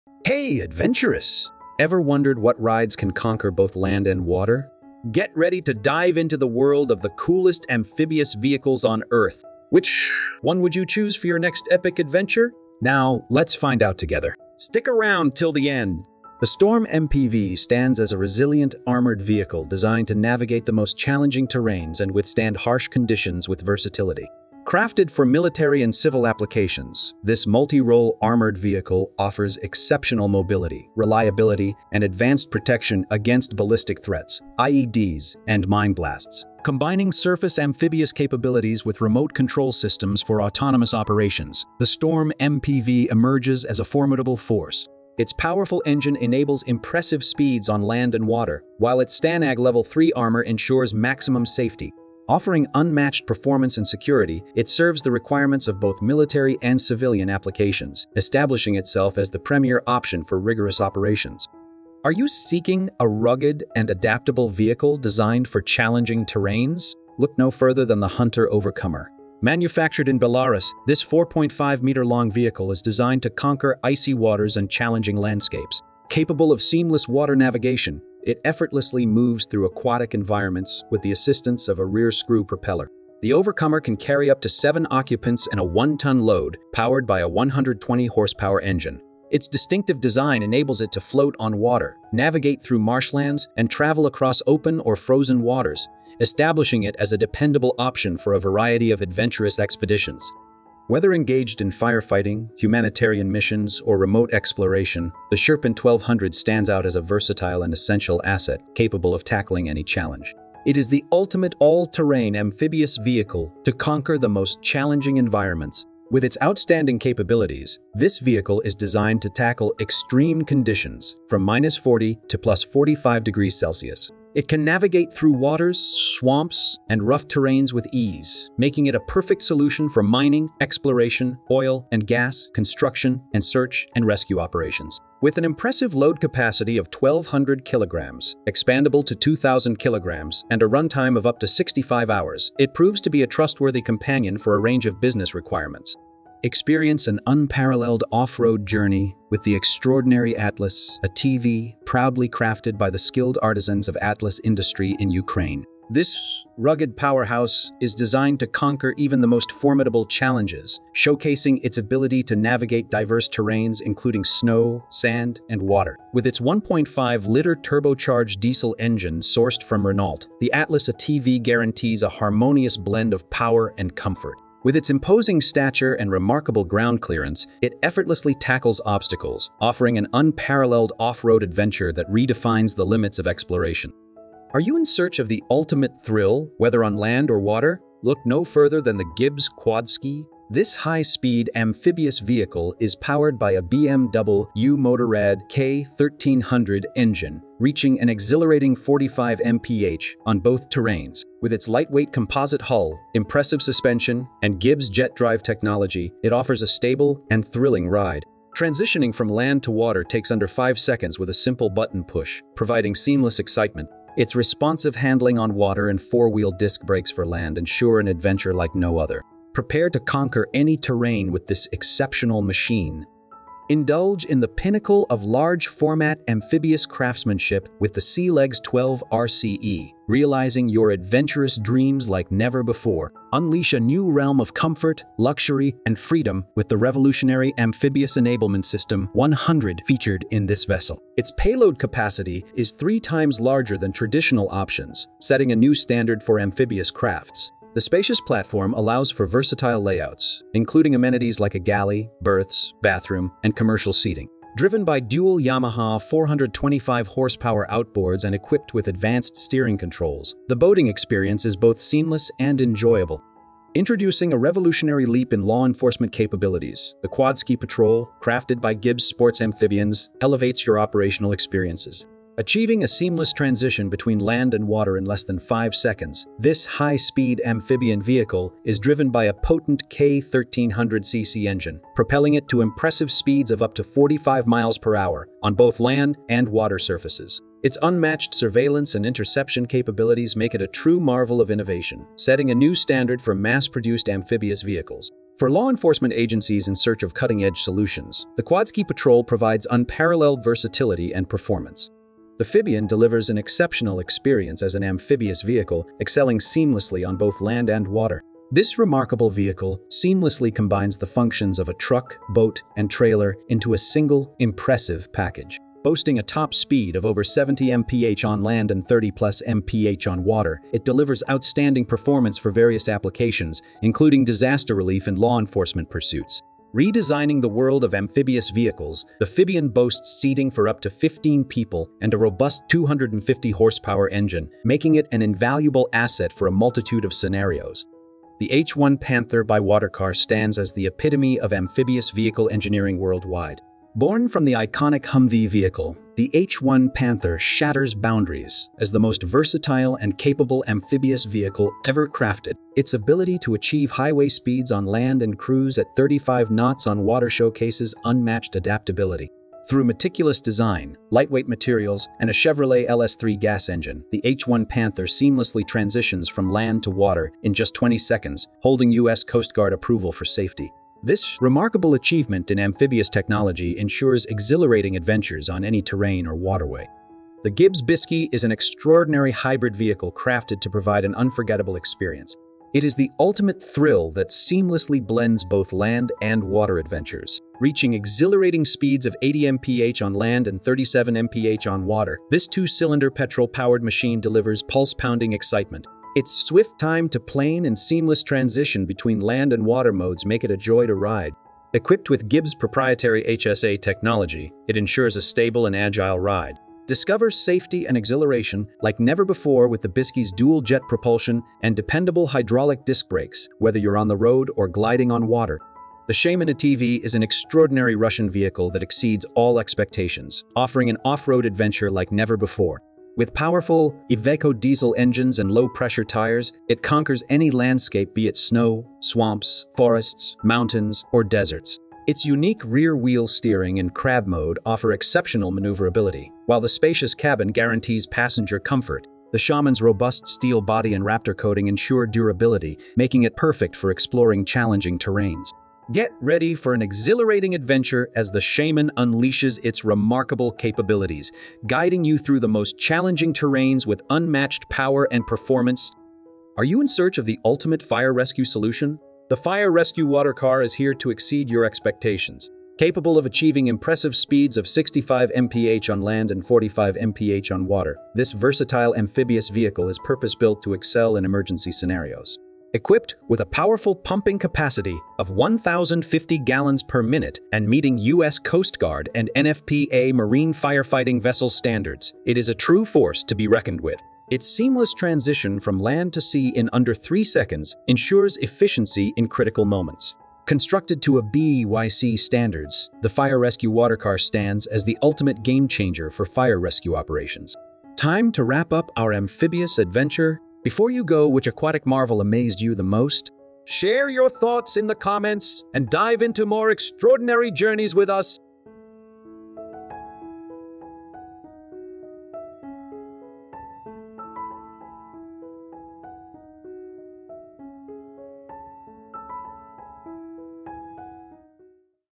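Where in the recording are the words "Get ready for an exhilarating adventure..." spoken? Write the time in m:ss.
7:25.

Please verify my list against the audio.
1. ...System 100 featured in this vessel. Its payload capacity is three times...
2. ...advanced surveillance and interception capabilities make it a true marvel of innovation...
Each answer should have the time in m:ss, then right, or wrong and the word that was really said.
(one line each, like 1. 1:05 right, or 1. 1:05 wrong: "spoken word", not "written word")
1. 3:58 right
2. 4:47 wrong: "unmatched", not "advanced".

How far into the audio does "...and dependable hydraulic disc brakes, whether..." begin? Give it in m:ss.
6:51.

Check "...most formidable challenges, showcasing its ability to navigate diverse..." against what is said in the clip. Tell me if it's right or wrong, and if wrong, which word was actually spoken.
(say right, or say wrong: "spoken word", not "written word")
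right.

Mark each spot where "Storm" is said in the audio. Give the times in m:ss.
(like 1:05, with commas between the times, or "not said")
0:16, 0:41.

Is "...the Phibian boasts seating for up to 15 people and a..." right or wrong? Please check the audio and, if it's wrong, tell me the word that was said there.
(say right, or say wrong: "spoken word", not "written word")
right.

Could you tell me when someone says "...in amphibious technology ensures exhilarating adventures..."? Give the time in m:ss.
6:12.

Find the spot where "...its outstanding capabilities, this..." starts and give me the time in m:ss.
1:56.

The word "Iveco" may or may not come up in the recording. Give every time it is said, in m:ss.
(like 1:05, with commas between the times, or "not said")
7:04.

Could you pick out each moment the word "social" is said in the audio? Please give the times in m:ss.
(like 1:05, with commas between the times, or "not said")
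not said.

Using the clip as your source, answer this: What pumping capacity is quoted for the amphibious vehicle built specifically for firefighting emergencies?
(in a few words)
1,050 gallons per minute.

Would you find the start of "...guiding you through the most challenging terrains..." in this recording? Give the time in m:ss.
7:31.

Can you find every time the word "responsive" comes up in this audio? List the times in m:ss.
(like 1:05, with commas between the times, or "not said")
3:34.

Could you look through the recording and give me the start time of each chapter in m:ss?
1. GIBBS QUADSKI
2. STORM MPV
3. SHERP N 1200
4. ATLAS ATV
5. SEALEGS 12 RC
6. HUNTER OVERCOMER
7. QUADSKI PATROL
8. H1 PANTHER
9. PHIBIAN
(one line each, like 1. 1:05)
1. 3:04
2. 0:16
3. 1:40
4. 2:26
5. 3:43
6. 1:01
7. 4:23
8. 5:37
9. 5:02.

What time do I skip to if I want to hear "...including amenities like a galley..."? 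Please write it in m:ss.
4:10.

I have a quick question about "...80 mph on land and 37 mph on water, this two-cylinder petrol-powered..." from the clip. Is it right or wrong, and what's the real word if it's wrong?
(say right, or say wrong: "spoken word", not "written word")
right.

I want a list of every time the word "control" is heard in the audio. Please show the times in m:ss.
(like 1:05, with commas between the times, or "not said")
0:39, 4:19.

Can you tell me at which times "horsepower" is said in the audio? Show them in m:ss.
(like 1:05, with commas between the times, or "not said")
1:27, 4:17, 5:33.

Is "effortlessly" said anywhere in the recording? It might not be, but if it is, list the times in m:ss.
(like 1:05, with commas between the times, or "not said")
1:18, 2:57.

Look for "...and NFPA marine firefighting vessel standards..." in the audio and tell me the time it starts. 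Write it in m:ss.
7:59.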